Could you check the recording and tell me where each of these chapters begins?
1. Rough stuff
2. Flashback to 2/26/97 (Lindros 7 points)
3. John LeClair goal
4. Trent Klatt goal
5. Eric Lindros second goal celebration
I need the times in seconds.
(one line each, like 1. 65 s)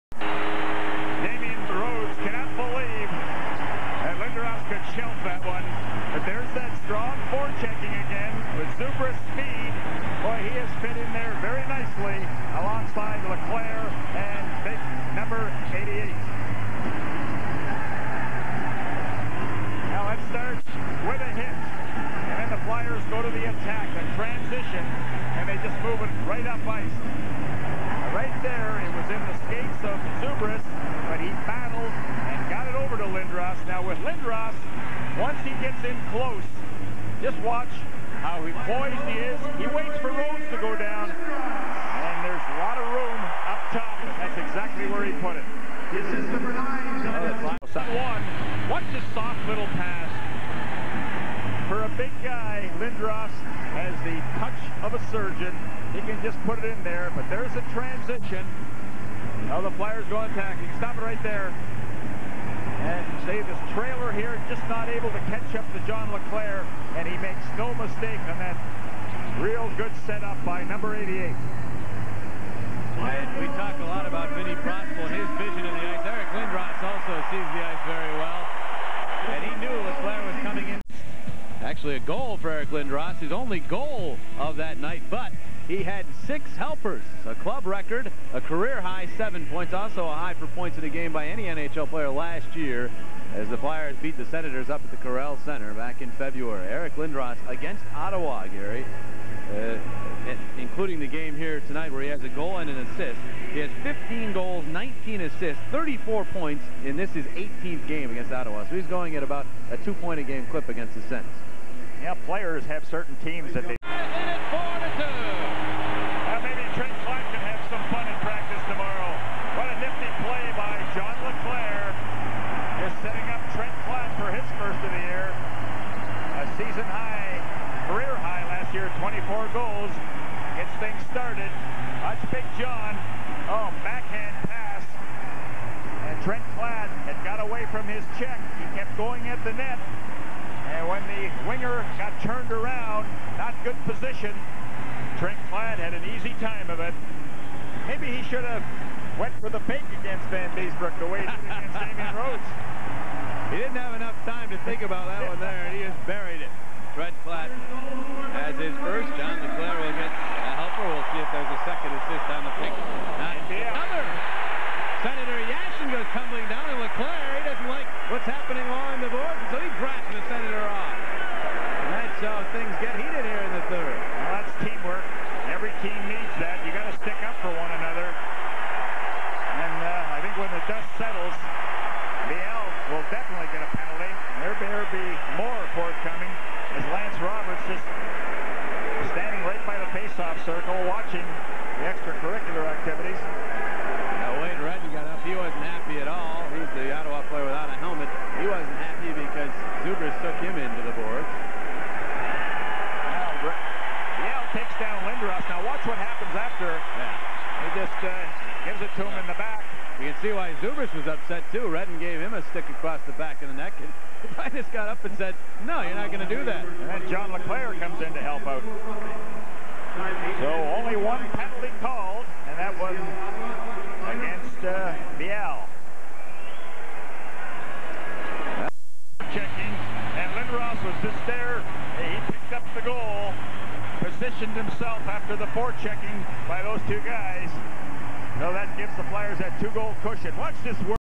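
1. 162 s
2. 81 s
3. 47 s
4. 113 s
5. 229 s.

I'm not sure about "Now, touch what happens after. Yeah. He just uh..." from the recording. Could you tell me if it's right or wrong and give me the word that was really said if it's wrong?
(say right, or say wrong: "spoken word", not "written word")
wrong: "watch", not "touch".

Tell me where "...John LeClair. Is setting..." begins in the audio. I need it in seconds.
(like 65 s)
120 s.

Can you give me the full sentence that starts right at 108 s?
So he's going at about a two-point-a-game clip against the Senators.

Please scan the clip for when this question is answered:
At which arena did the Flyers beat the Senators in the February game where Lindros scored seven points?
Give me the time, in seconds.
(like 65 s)
94 s.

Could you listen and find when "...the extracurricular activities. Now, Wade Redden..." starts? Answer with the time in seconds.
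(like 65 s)
191 s.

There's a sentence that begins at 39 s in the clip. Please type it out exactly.
He waits for Rhodes to go down.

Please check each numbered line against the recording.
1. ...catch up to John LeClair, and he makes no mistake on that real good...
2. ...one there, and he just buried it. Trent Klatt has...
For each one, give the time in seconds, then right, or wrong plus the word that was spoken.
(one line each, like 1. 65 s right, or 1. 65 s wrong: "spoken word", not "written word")
1. 65 s right
2. 155 s right.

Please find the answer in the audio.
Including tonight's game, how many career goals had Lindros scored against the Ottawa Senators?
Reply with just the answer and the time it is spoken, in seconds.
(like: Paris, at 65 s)
15, at 103 s.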